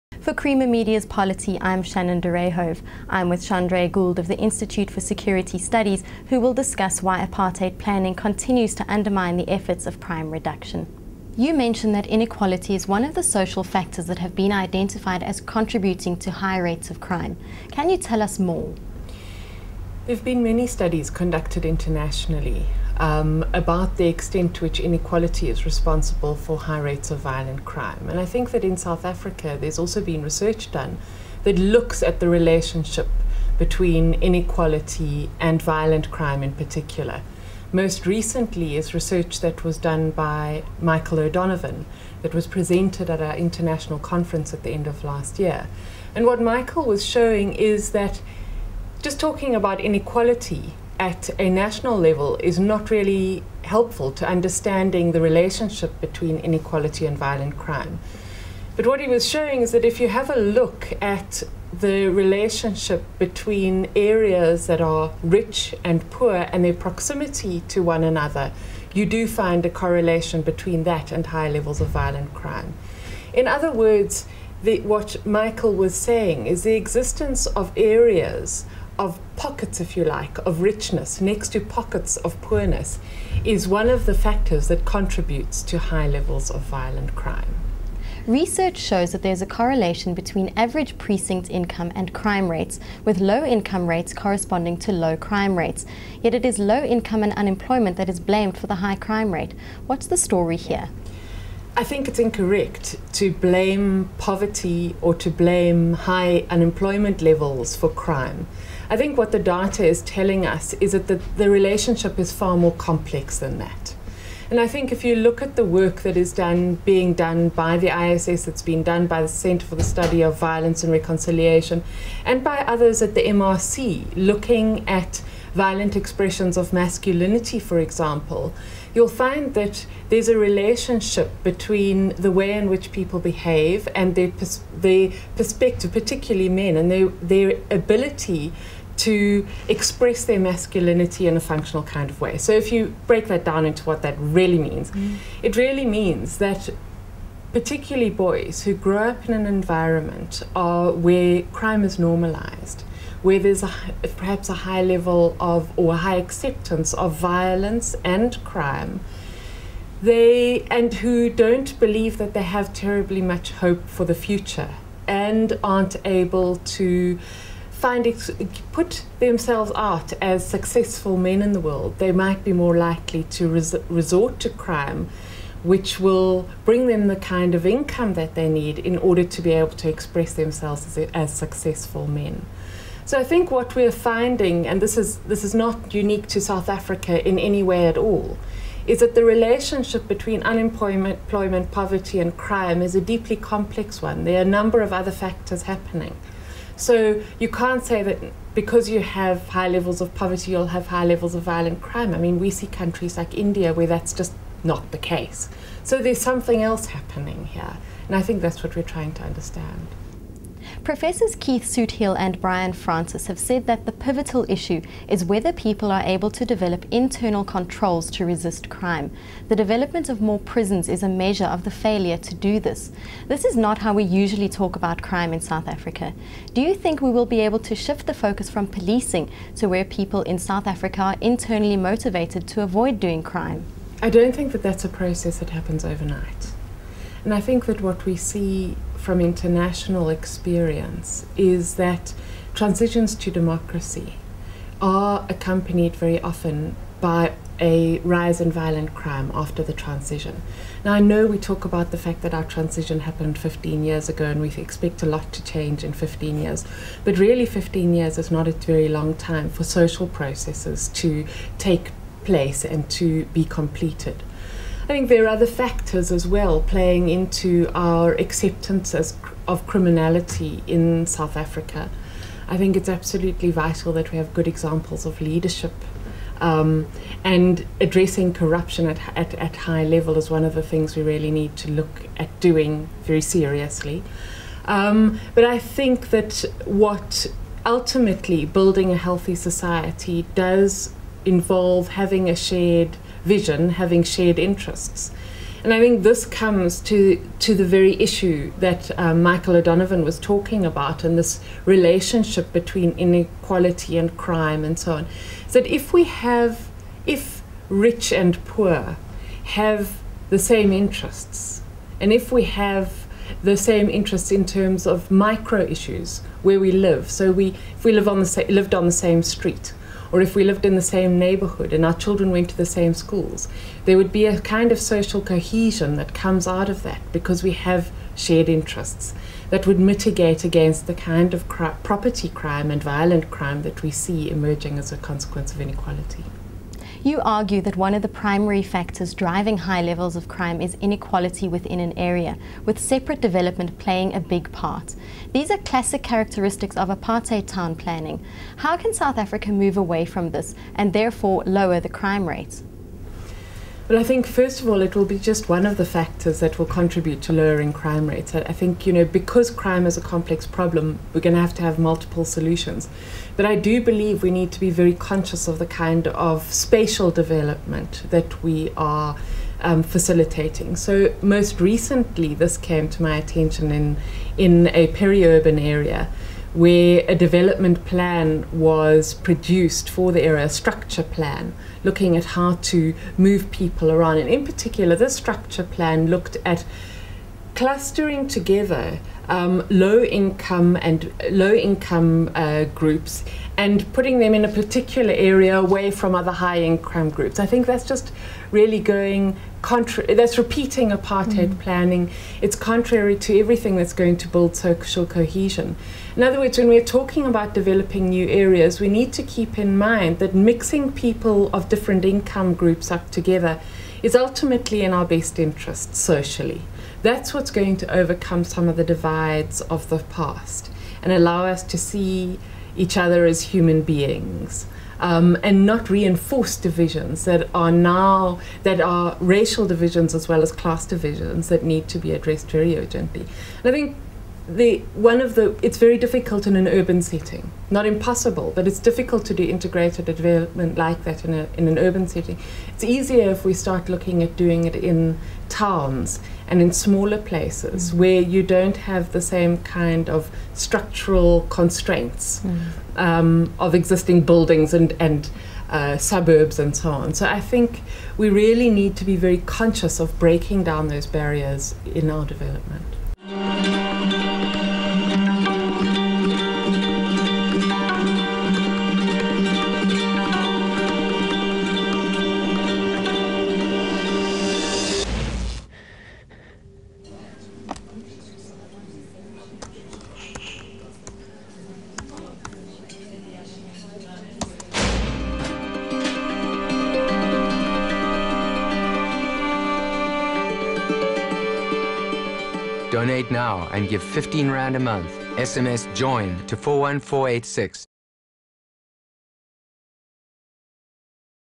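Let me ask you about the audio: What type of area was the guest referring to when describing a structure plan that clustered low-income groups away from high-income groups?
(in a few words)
peri-urban area.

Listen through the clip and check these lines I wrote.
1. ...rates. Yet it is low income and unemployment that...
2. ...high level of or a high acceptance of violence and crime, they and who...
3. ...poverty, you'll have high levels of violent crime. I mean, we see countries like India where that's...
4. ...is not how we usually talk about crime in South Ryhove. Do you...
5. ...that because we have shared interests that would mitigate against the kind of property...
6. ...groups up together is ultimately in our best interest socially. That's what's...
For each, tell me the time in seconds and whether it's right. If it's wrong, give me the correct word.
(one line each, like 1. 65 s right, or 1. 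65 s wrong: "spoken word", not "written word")
1. 95 s right
2. 154 s right
3. 200 s right
4. 223 s wrong: "Africa", not "Ryhove"
5. 326 s right
6. 412 s right.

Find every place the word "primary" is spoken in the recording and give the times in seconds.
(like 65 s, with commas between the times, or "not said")
338 s.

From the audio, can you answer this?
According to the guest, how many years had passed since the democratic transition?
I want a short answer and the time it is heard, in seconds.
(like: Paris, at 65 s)
15, at 253 s.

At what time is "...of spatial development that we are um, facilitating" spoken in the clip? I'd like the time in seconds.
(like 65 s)
366 s.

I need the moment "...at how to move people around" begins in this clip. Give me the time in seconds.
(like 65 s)
382 s.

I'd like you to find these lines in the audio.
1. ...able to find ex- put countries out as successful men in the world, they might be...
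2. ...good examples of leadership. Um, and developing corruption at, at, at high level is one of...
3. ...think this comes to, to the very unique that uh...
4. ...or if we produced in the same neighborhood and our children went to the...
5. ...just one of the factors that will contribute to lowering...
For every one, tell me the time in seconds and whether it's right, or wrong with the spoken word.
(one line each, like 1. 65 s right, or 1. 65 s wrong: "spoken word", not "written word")
1. 166 s wrong: "themselves", not "countries"
2. 274 s wrong: "addressing", not "developing"
3. 295 s wrong: "issue", not "unique"
4. 320 s wrong: "lived", not "produced"
5. 355 s right.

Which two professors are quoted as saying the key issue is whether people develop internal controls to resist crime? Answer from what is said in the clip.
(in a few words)
Keith Soothill and Brian Francis.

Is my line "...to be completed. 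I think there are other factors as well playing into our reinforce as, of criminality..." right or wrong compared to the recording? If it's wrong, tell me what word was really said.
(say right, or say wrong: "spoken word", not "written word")
wrong: "acceptance", not "reinforce".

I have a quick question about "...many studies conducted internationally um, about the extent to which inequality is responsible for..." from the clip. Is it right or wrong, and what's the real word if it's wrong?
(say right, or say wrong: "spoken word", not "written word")
right.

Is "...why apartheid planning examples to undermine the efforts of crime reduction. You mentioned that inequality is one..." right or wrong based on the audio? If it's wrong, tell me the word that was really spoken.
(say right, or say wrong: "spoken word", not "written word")
wrong: "continues", not "examples".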